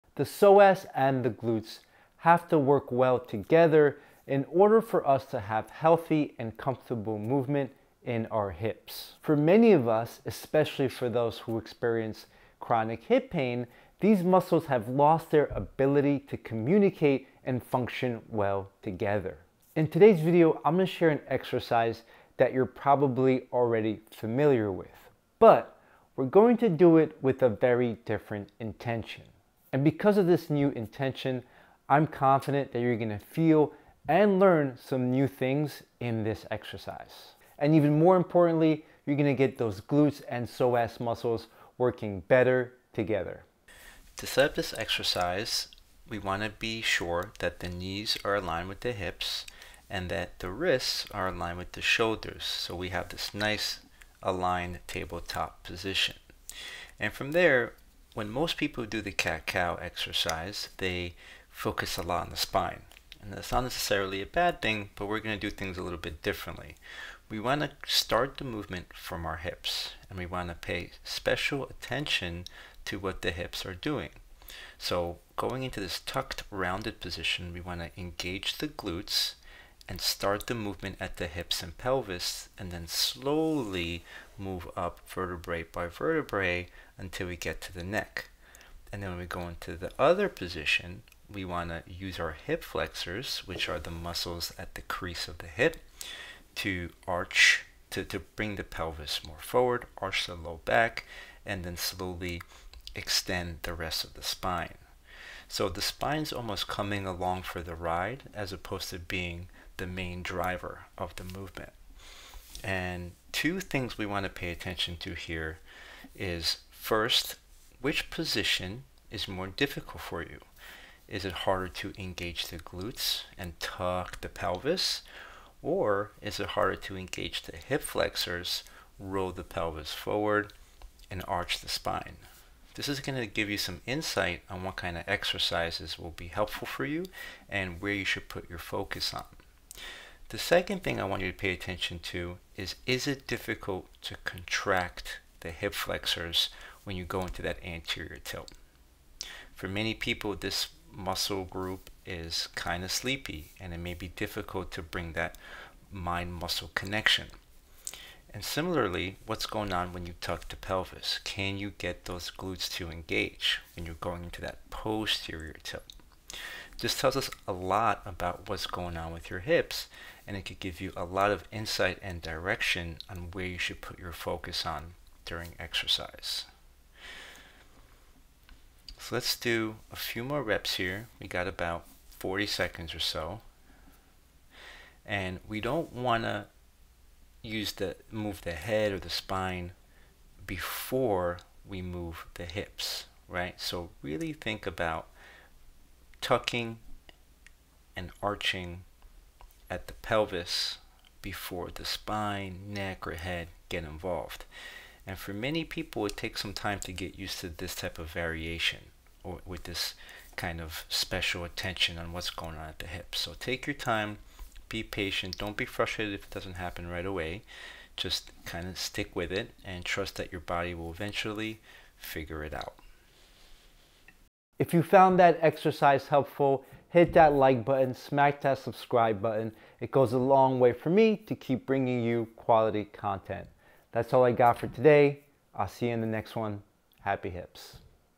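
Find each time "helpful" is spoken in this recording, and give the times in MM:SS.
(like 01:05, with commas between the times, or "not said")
02:16, 03:46.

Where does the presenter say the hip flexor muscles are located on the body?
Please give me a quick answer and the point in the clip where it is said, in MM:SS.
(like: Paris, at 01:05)
crease of the hip, at 01:34.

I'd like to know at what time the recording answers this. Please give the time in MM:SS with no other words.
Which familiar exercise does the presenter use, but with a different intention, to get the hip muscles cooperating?
00:59.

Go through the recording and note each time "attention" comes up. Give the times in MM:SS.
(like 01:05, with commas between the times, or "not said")
01:11, 01:54, 02:21, 03:31.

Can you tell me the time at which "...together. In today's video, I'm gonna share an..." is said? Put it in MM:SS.
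00:18.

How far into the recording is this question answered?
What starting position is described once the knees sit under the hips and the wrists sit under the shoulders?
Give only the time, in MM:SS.
00:54.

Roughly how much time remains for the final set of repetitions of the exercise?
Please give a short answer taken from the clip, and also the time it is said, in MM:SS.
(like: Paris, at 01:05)
40 seconds, at 03:02.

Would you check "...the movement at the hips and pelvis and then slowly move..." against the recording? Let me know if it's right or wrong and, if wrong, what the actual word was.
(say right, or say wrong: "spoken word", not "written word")
right.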